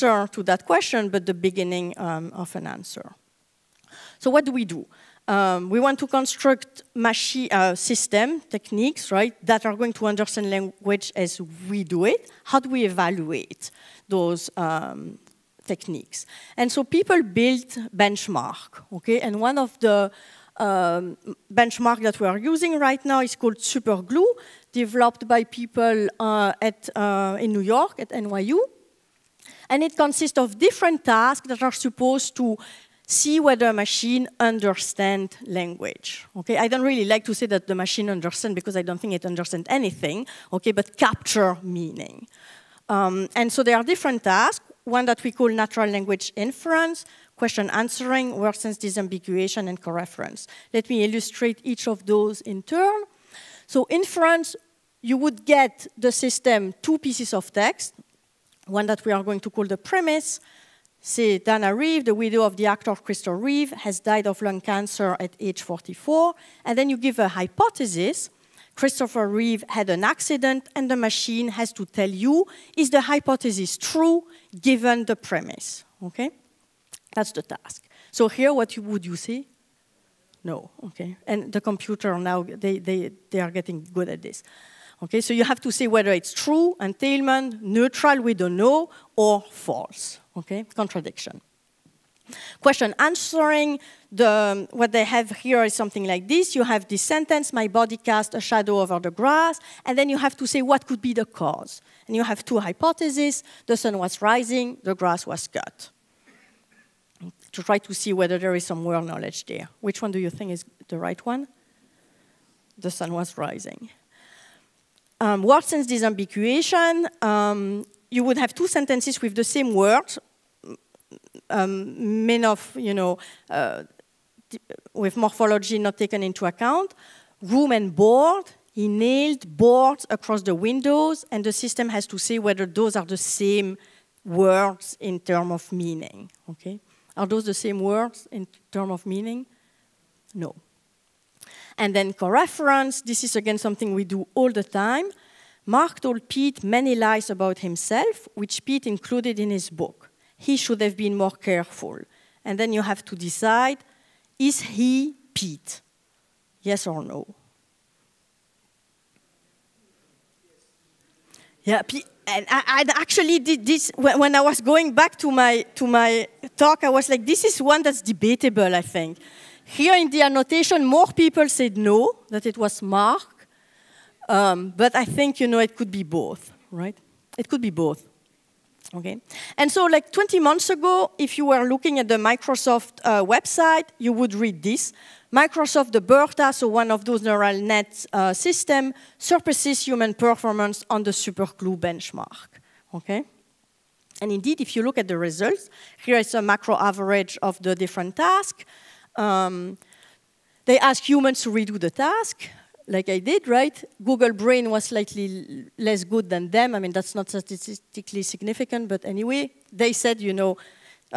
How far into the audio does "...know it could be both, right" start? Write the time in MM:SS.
02:55.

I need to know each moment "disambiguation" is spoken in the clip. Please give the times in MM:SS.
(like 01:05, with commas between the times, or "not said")
00:48, 01:55.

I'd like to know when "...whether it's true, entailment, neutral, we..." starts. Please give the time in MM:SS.
01:25.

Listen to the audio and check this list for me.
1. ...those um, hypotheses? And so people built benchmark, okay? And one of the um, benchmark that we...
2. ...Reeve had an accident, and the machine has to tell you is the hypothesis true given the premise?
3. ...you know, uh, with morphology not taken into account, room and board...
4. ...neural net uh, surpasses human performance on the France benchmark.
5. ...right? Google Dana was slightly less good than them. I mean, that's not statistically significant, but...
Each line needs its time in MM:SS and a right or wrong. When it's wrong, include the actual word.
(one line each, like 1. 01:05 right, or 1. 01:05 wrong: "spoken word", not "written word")
1. 00:14 wrong: "techniques", not "hypotheses"
2. 01:09 right
3. 02:02 right
4. 03:07 wrong: "SuperGLUE", not "France"
5. 03:23 wrong: "Brain", not "Dana".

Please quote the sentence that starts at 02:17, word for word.
Are those the same words in terms of meaning?